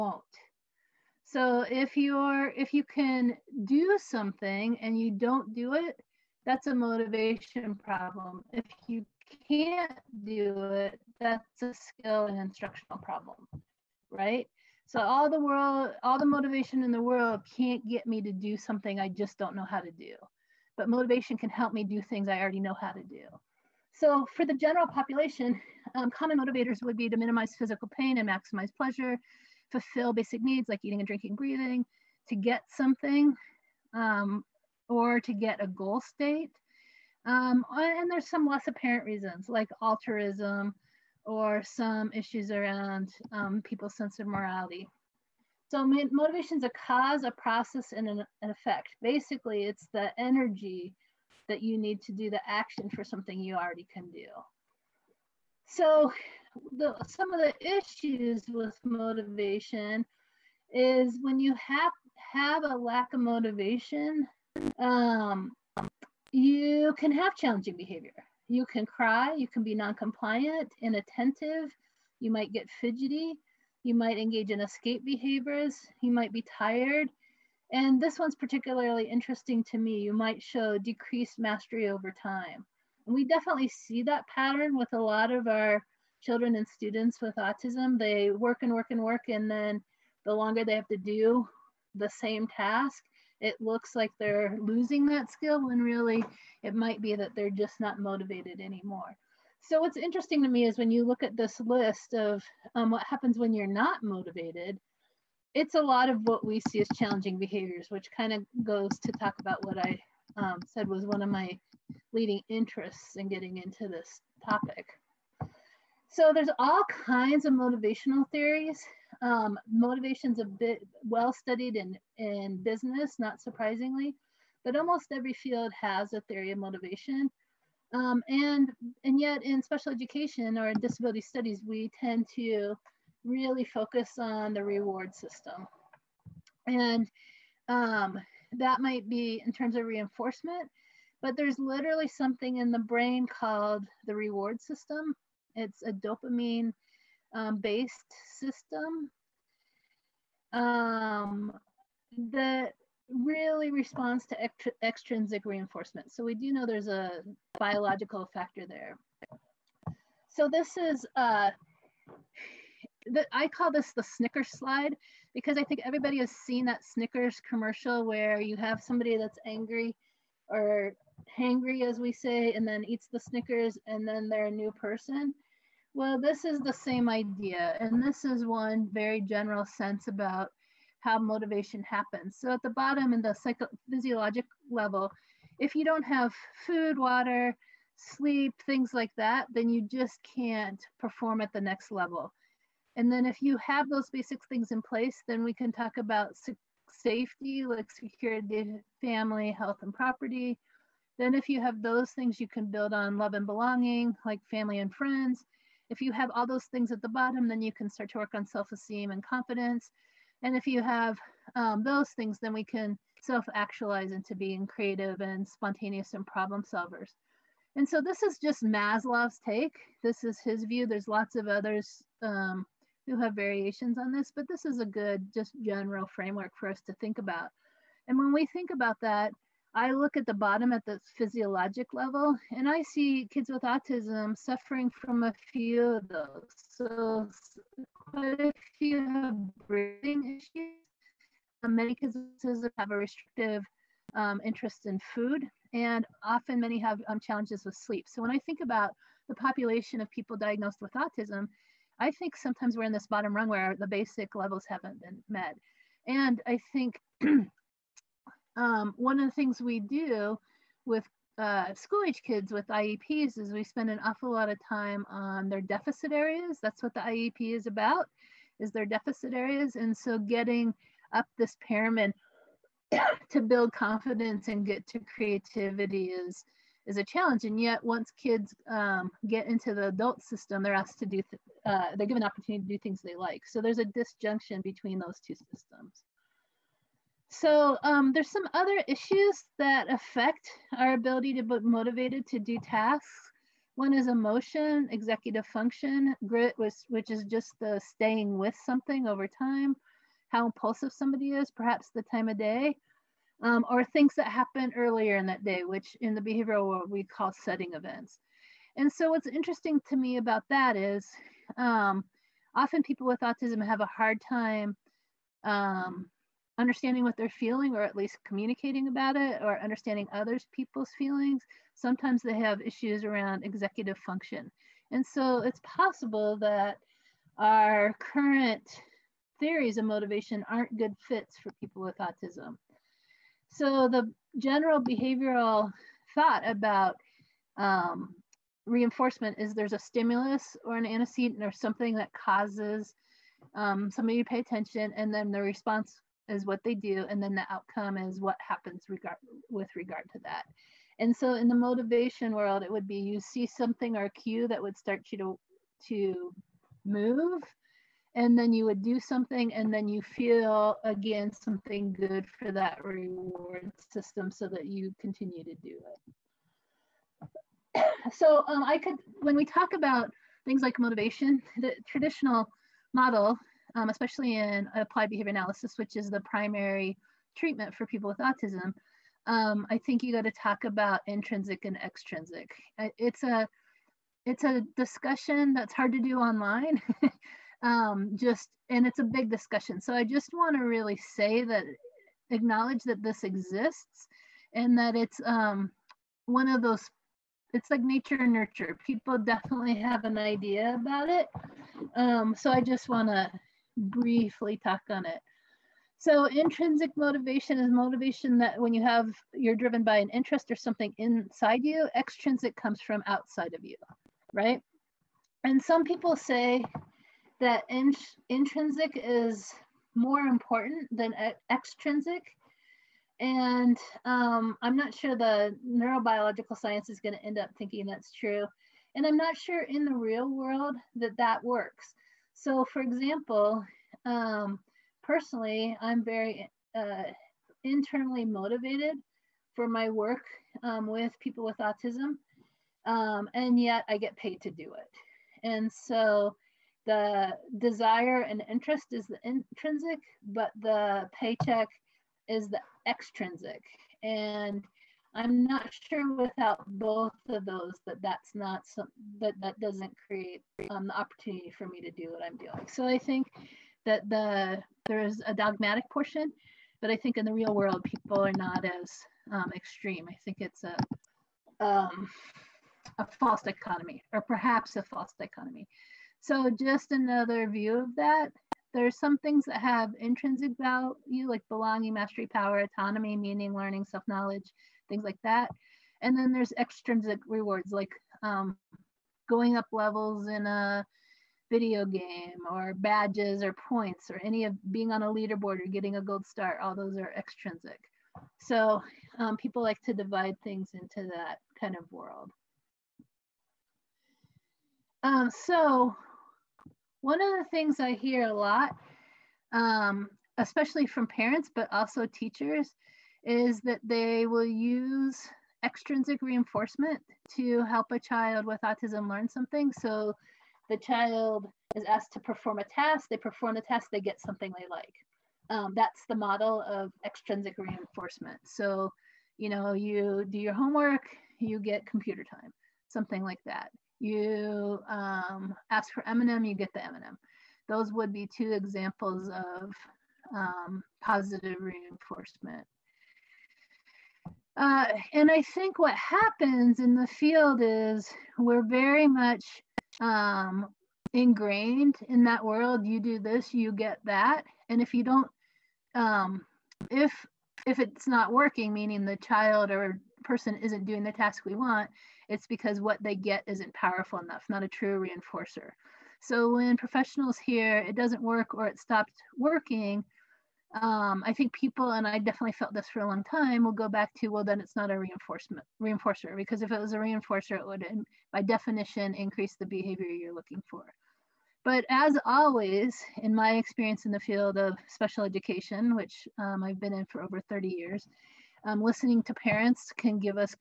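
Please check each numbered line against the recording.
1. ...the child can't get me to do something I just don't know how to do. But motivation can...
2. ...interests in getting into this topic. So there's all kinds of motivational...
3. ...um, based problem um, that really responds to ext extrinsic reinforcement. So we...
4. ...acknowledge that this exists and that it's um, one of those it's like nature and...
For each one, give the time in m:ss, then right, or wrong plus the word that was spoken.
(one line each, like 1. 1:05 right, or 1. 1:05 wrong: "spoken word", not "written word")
1. 0:16 wrong: "world", not "child"
2. 1:52 right
3. 2:27 wrong: "system", not "problem"
4. 6:32 right.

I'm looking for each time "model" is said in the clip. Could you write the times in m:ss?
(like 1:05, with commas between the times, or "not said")
6:12, 8:46.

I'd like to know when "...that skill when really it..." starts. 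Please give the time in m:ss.
1:35.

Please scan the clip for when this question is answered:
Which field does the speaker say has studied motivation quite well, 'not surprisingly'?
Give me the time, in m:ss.
2:02.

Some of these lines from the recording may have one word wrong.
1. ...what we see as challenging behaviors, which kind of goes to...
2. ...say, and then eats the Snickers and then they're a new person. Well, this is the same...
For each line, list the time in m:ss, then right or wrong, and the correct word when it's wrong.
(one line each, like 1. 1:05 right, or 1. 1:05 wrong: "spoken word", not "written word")
1. 1:46 right
2. 2:52 right.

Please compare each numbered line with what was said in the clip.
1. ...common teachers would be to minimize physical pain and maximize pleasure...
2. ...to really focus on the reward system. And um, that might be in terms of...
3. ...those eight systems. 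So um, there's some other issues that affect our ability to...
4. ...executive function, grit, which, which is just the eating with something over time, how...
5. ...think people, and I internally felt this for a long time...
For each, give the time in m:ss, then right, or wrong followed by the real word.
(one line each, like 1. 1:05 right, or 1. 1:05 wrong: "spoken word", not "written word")
1. 0:26 wrong: "motivators", not "teachers"
2. 2:12 right
3. 4:44 wrong: "two", not "eight"
4. 4:54 wrong: "staying", not "eating"
5. 9:31 wrong: "definitely", not "internally".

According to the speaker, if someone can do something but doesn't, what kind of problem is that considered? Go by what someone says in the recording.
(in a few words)
motivation problem.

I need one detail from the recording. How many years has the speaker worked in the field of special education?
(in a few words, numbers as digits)
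over 30.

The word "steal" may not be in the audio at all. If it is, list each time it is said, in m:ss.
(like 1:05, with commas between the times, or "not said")
not said.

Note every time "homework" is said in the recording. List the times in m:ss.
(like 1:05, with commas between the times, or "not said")
8:50.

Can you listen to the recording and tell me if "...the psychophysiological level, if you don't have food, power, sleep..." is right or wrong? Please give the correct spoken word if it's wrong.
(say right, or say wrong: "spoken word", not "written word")
wrong: "water", not "power".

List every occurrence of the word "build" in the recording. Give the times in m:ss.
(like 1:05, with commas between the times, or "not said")
3:22, 4:33.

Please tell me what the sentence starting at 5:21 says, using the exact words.
Sometimes they have issues around executive function.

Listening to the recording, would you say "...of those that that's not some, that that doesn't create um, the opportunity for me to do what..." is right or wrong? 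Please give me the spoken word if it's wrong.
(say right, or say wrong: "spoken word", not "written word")
right.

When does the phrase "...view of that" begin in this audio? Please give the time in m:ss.
7:57.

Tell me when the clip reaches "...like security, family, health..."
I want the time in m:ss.
3:17.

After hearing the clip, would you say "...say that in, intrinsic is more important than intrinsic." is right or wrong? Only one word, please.
wrong.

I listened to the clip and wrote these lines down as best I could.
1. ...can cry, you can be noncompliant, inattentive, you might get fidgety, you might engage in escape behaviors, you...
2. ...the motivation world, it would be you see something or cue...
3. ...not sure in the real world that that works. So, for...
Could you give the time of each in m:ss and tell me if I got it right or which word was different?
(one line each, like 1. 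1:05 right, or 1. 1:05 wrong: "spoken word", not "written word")
1. 1:08 right
2. 5:51 right
3. 7:09 right.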